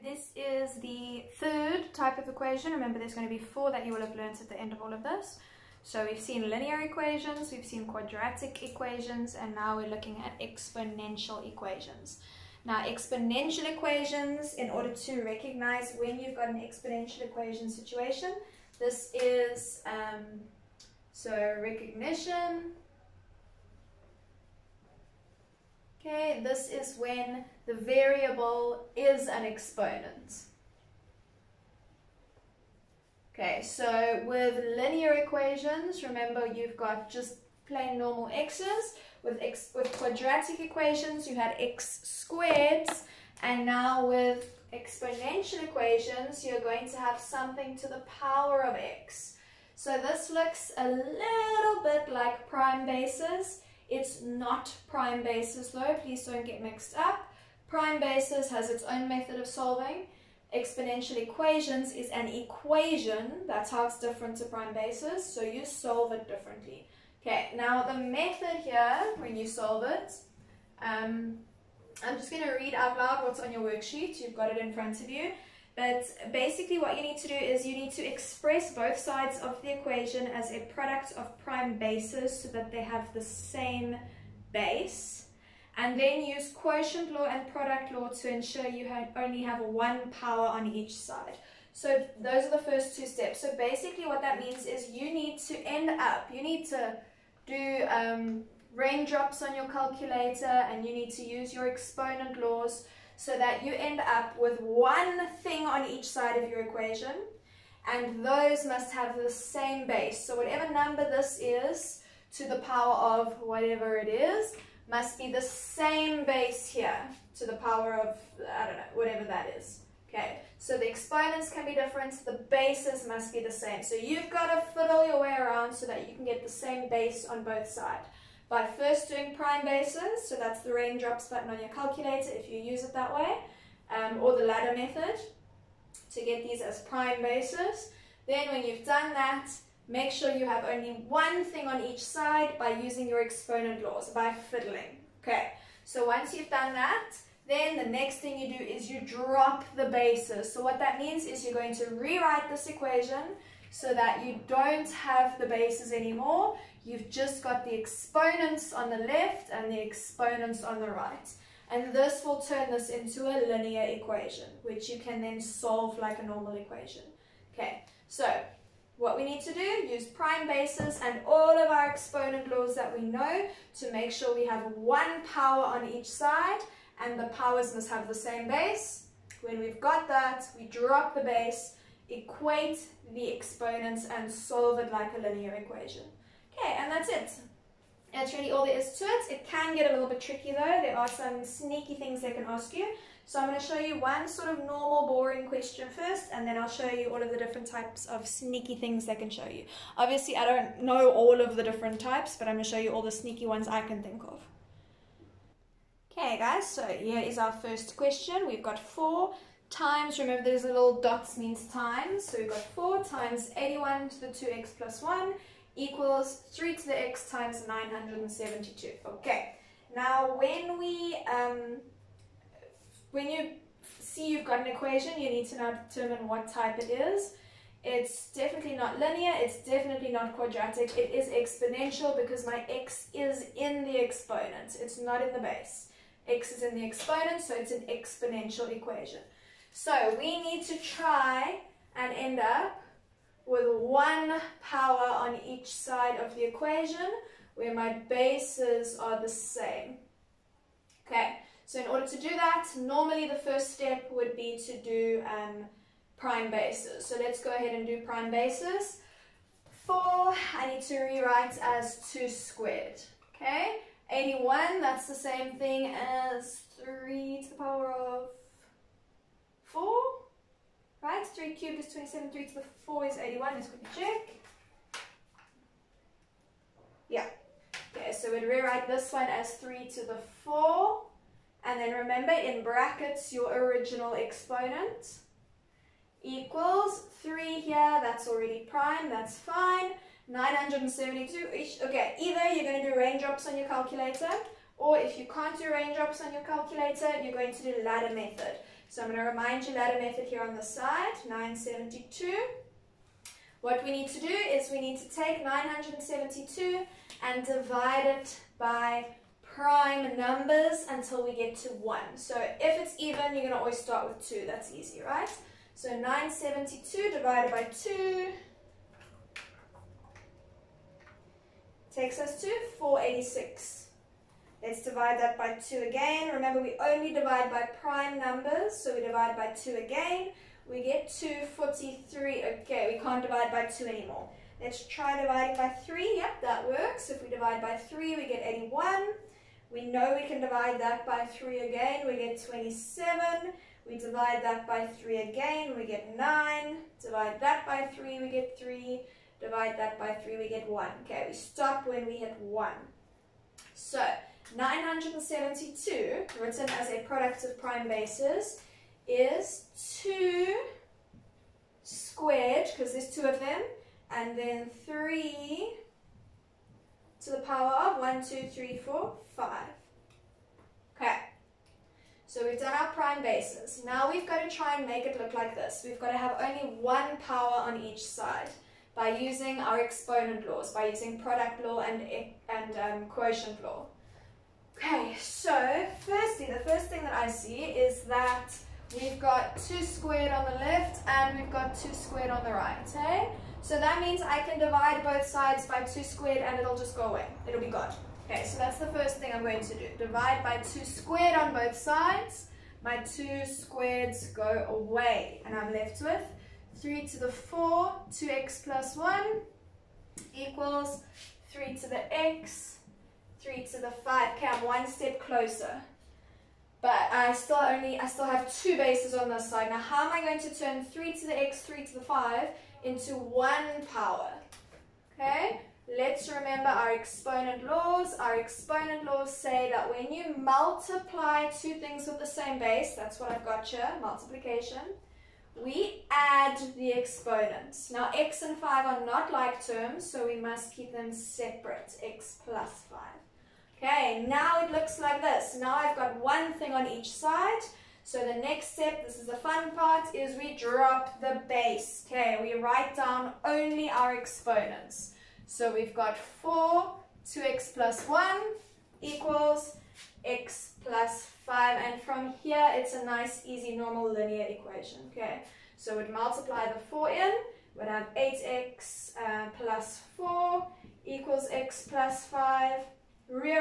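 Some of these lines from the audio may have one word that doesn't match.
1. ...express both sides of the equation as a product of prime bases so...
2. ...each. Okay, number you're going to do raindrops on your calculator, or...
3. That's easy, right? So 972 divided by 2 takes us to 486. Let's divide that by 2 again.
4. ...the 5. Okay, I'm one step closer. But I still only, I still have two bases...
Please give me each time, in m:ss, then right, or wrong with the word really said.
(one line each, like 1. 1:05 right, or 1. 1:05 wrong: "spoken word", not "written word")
1. 1:18 right
2. 4:51 wrong: "either", not "number"
3. 5:14 right
4. 6:53 right.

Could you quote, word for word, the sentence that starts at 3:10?
There are some sneaky things they can ask you.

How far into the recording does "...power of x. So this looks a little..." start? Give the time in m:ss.
0:48.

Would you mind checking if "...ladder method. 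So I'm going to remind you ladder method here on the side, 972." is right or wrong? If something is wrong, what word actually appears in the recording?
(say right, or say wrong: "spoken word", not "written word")
right.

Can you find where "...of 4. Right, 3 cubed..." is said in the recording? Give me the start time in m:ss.
4:27.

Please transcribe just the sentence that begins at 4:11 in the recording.
Okay, so in order to do that, normally the first step would be to do um, prime bases.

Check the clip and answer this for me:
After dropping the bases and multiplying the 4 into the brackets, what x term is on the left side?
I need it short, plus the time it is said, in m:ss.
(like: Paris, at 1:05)
8x, at 7:48.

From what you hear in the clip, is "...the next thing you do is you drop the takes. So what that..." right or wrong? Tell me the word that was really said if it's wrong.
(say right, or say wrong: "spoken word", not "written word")
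wrong: "bases", not "takes".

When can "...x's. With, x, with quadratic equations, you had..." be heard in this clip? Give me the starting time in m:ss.
0:38.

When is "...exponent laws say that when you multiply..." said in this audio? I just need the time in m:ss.
7:08.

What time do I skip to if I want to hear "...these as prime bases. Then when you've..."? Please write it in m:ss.
2:16.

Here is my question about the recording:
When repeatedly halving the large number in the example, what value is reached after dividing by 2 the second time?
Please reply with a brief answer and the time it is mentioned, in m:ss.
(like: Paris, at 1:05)
243, at 5:31.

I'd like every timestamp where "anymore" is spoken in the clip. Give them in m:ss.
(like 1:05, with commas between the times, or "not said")
2:35, 5:33.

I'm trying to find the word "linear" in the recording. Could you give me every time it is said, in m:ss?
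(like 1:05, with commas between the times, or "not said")
0:06, 0:34, 2:43, 3:05, 3:48, 7:44.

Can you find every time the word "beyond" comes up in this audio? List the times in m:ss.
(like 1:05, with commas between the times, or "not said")
not said.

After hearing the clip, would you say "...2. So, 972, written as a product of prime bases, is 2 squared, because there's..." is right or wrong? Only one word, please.
wrong.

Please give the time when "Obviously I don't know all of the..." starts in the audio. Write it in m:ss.
3:19.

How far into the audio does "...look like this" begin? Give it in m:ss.
6:15.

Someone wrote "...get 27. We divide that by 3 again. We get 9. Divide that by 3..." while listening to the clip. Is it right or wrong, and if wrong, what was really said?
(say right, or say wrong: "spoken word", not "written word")
right.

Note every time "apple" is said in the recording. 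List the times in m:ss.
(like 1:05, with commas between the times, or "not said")
not said.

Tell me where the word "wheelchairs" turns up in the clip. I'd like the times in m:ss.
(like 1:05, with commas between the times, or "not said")
not said.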